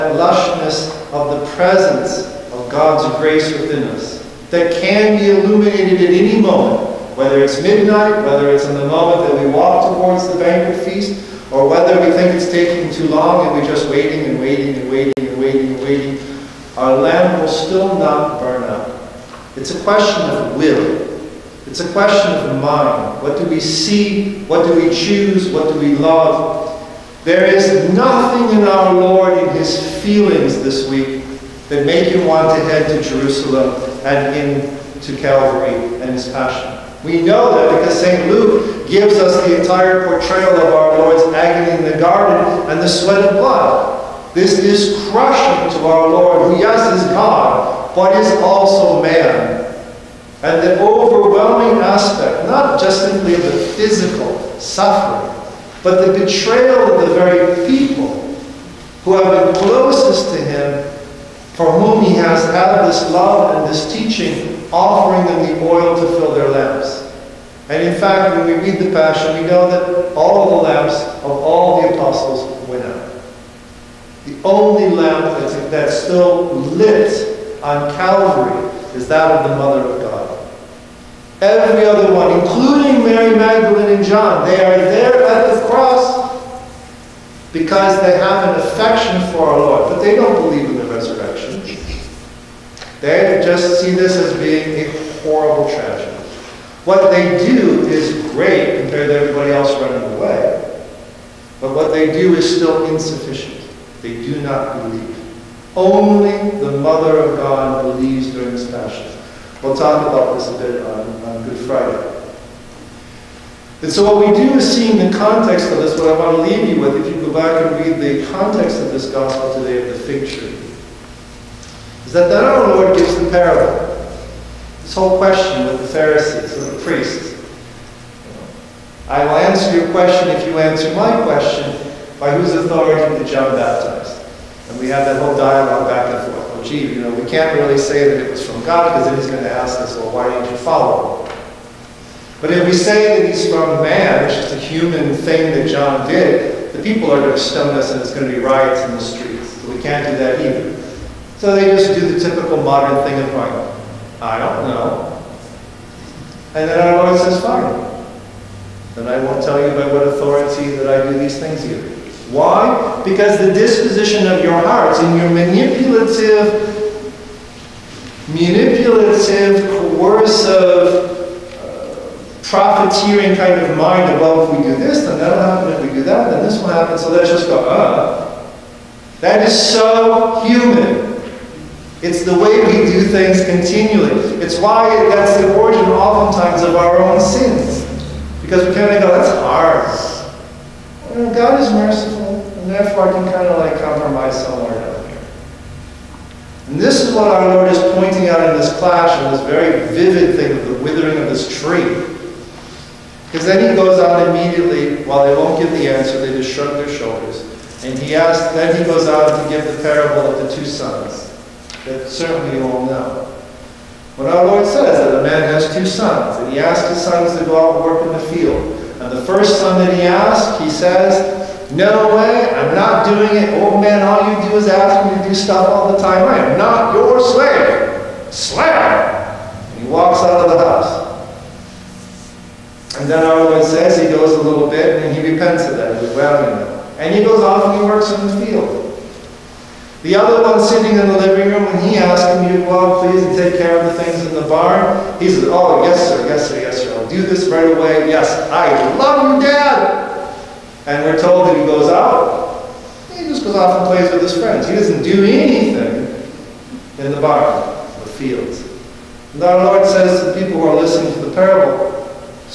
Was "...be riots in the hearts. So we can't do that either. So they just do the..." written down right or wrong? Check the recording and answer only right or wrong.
wrong.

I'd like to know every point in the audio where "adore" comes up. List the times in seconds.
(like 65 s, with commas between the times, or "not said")
not said.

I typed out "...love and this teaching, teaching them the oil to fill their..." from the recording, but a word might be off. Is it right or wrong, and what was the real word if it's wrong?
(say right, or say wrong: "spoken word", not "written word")
wrong: "offering", not "teaching".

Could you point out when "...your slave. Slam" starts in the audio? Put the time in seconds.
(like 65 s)
226 s.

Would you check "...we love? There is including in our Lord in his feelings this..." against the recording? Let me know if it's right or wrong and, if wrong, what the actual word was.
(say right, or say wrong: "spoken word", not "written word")
wrong: "nothing", not "including".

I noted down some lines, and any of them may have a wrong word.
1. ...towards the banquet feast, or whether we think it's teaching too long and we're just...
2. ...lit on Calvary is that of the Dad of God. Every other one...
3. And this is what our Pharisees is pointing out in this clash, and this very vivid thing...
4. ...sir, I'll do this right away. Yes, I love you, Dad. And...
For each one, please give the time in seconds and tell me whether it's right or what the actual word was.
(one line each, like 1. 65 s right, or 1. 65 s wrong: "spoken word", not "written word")
1. 9 s wrong: "taking", not "teaching"
2. 76 s wrong: "Mother", not "Dad"
3. 196 s wrong: "Lord", not "Pharisees"
4. 246 s right.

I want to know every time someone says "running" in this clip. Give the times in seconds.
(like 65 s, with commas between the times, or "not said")
99 s.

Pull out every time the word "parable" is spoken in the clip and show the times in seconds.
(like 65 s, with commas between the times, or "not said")
123 s, 209 s, 261 s.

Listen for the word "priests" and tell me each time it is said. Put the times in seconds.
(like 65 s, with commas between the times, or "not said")
126 s.